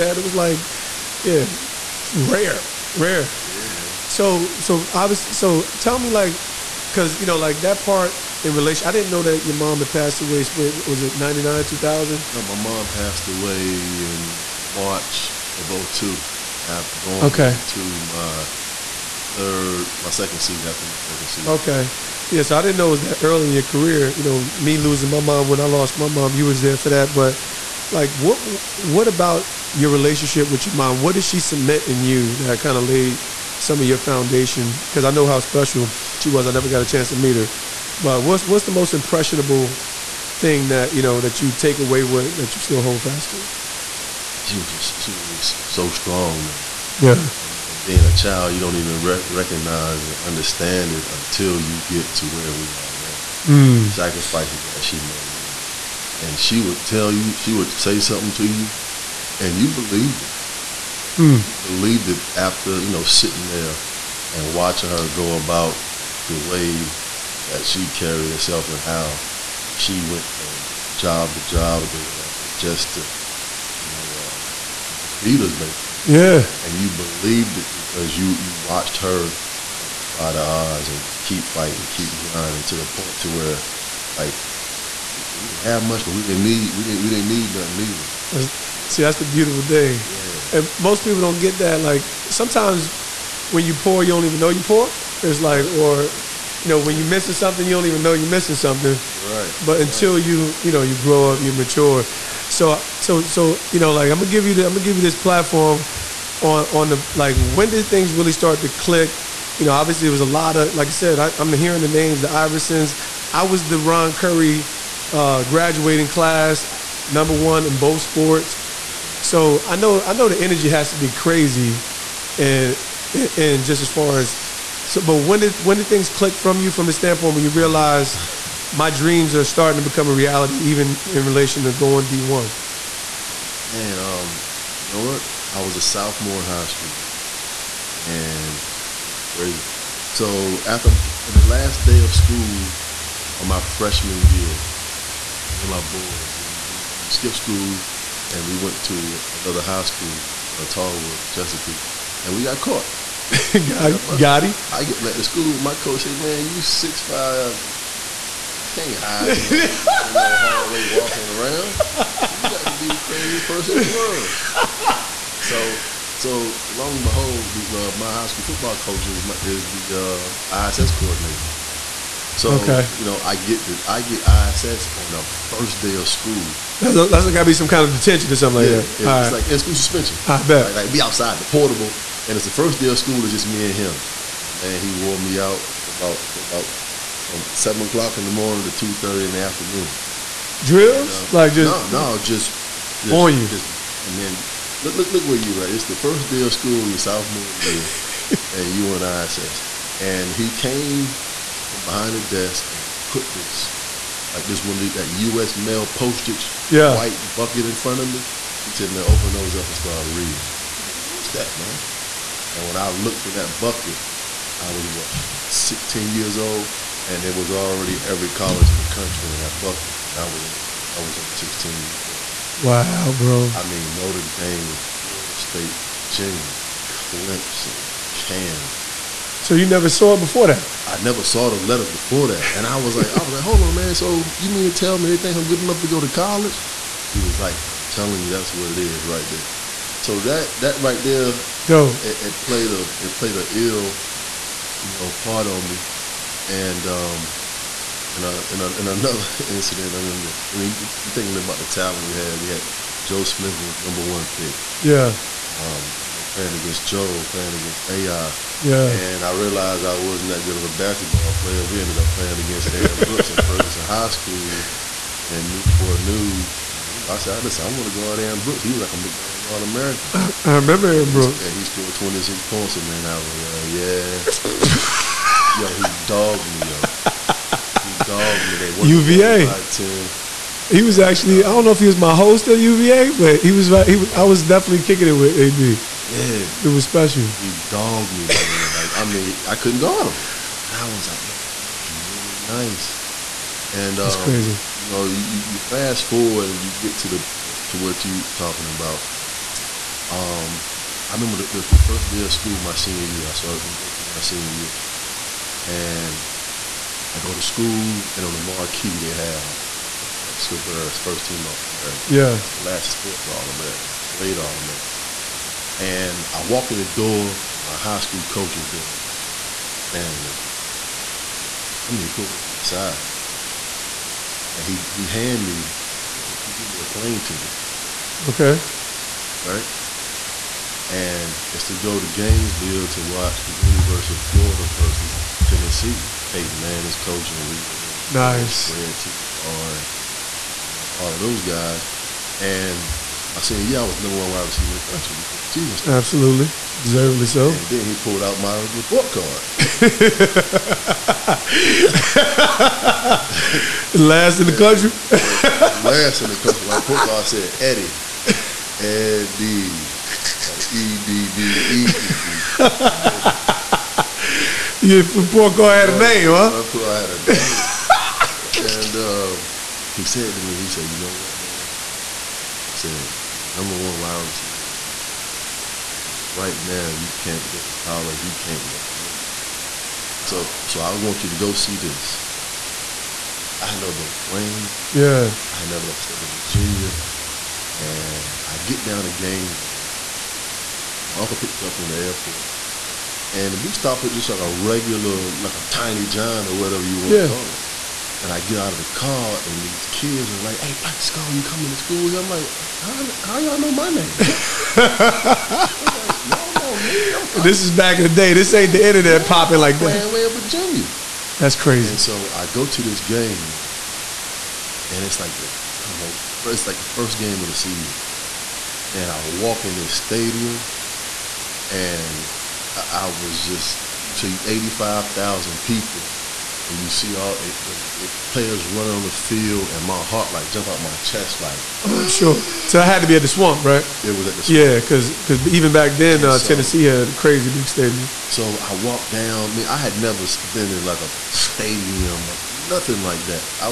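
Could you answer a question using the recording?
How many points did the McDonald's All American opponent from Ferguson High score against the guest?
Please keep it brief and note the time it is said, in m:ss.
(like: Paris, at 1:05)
26, at 4:31.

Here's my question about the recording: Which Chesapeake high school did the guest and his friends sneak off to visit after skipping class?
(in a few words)
Tallwood.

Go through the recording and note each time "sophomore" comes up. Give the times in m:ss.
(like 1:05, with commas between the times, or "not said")
2:15, 3:16.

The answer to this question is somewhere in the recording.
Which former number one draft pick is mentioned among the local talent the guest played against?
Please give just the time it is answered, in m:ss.
4:12.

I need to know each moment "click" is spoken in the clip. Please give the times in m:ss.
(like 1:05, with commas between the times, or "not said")
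1:48, 2:06.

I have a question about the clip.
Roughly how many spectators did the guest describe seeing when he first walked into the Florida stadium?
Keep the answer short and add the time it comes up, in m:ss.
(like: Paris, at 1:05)
85,000, at 7:04.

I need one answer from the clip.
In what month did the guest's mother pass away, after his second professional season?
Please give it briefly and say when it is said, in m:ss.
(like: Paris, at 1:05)
March, at 0:14.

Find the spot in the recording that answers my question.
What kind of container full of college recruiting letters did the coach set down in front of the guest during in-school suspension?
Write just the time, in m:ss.
3:26.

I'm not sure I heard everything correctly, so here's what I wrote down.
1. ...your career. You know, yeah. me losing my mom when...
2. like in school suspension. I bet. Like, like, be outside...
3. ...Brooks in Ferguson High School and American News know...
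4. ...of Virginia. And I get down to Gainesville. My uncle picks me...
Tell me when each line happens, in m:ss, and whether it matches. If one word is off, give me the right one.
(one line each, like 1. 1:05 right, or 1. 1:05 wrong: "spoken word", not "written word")
1. 0:23 right
2. 2:59 right
3. 4:22 wrong: "Newport", not "American"
4. 6:26 right.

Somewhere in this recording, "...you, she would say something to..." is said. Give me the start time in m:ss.
0:57.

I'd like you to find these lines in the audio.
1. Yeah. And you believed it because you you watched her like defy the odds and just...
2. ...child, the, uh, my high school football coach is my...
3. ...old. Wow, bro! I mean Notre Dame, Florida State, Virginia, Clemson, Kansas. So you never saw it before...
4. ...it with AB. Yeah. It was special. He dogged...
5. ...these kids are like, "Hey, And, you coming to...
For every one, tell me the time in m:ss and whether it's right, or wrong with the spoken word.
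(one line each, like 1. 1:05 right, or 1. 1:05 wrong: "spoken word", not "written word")
1. 1:16 right
2. 2:47 wrong: "behold", not "child"
3. 3:42 right
4. 4:45 right
5. 6:39 wrong: "Plaxico", not "And".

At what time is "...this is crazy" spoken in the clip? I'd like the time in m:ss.
2:19.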